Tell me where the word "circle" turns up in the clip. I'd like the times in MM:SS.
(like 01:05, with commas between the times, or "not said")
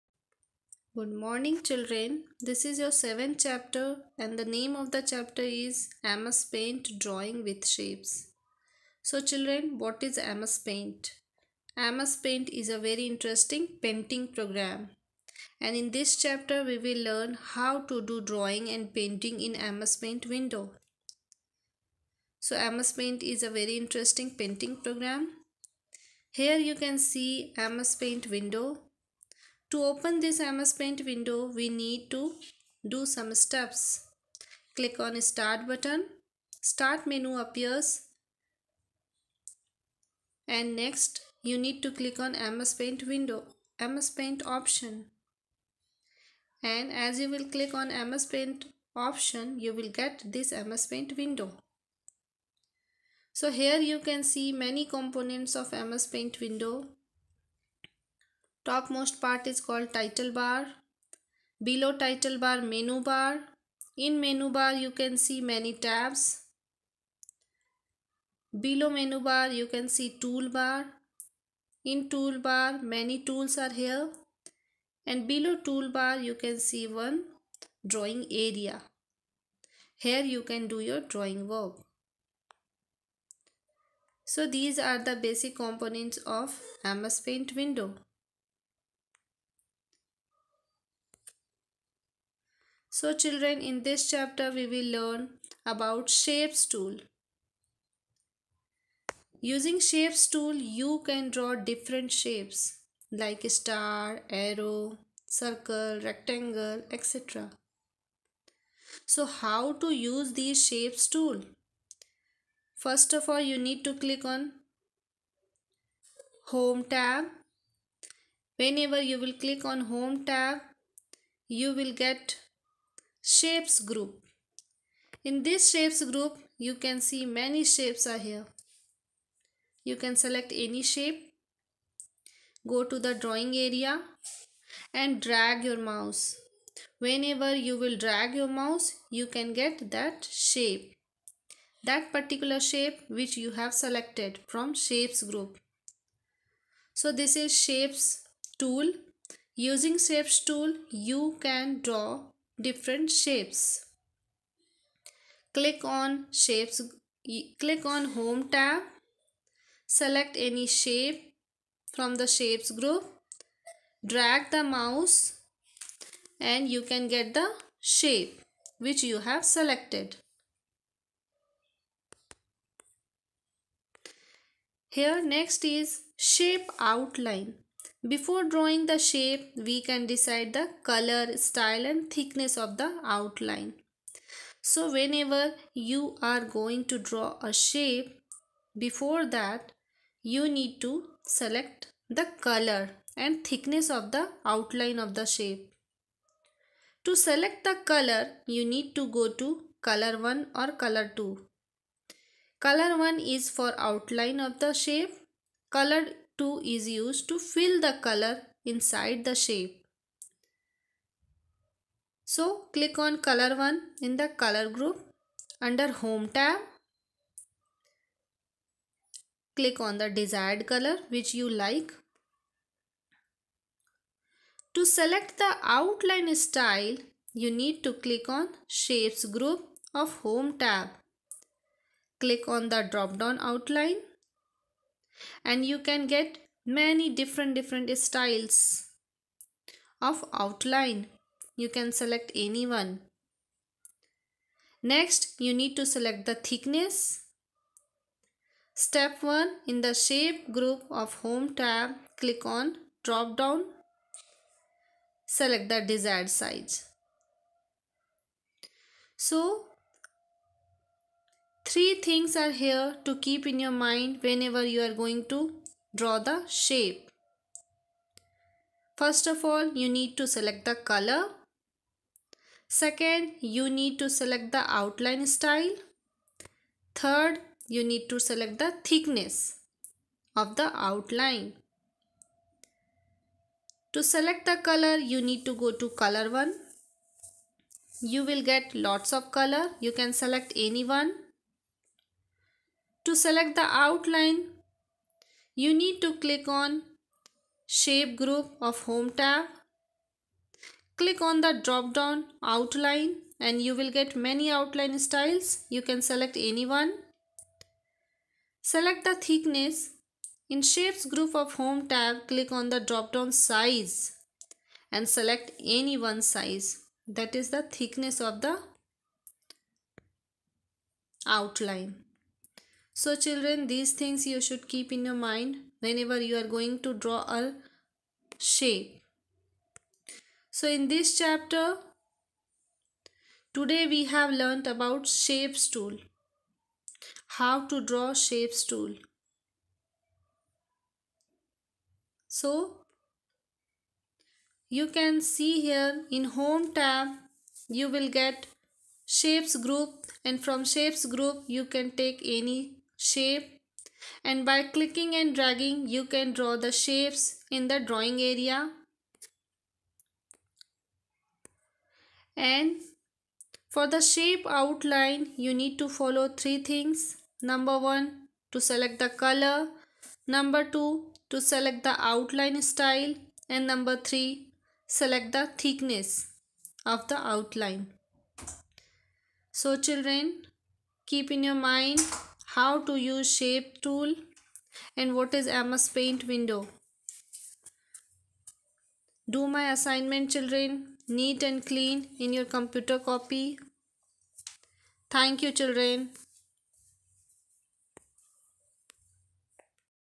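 01:45.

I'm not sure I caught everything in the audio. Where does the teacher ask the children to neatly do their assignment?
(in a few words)
Computer copy.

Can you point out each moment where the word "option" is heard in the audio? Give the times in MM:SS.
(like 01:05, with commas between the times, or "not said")
00:44, 00:48.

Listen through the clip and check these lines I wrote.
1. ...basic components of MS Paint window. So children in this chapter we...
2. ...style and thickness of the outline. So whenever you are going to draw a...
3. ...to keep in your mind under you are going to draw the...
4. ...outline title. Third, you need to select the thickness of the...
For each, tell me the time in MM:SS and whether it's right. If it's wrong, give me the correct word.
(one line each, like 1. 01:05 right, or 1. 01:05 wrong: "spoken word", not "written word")
1. 01:25 right
2. 03:01 right
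3. 04:23 wrong: "whenever", not "under"
4. 04:34 wrong: "style", not "title".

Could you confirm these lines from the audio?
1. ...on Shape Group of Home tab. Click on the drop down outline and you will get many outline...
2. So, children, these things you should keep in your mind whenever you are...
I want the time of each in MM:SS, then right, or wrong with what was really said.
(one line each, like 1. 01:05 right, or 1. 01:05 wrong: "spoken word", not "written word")
1. 04:56 right
2. 05:22 right.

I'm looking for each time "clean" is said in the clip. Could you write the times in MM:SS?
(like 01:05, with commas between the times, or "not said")
06:31.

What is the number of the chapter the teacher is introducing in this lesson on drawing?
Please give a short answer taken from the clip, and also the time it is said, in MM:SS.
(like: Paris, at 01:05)
7, at 00:02.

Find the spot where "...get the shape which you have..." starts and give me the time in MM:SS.
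02:47.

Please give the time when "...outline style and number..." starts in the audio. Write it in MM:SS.
06:12.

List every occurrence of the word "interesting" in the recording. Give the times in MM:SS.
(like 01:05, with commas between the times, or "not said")
00:13, 00:23.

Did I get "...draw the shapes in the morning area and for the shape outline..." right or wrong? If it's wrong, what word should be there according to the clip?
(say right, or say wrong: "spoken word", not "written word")
wrong: "drawing", not "morning".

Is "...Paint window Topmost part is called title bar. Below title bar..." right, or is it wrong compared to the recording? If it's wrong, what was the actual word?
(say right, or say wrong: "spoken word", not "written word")
right.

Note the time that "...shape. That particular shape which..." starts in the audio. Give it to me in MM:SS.
02:20.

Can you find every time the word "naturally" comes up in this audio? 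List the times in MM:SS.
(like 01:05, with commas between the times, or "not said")
not said.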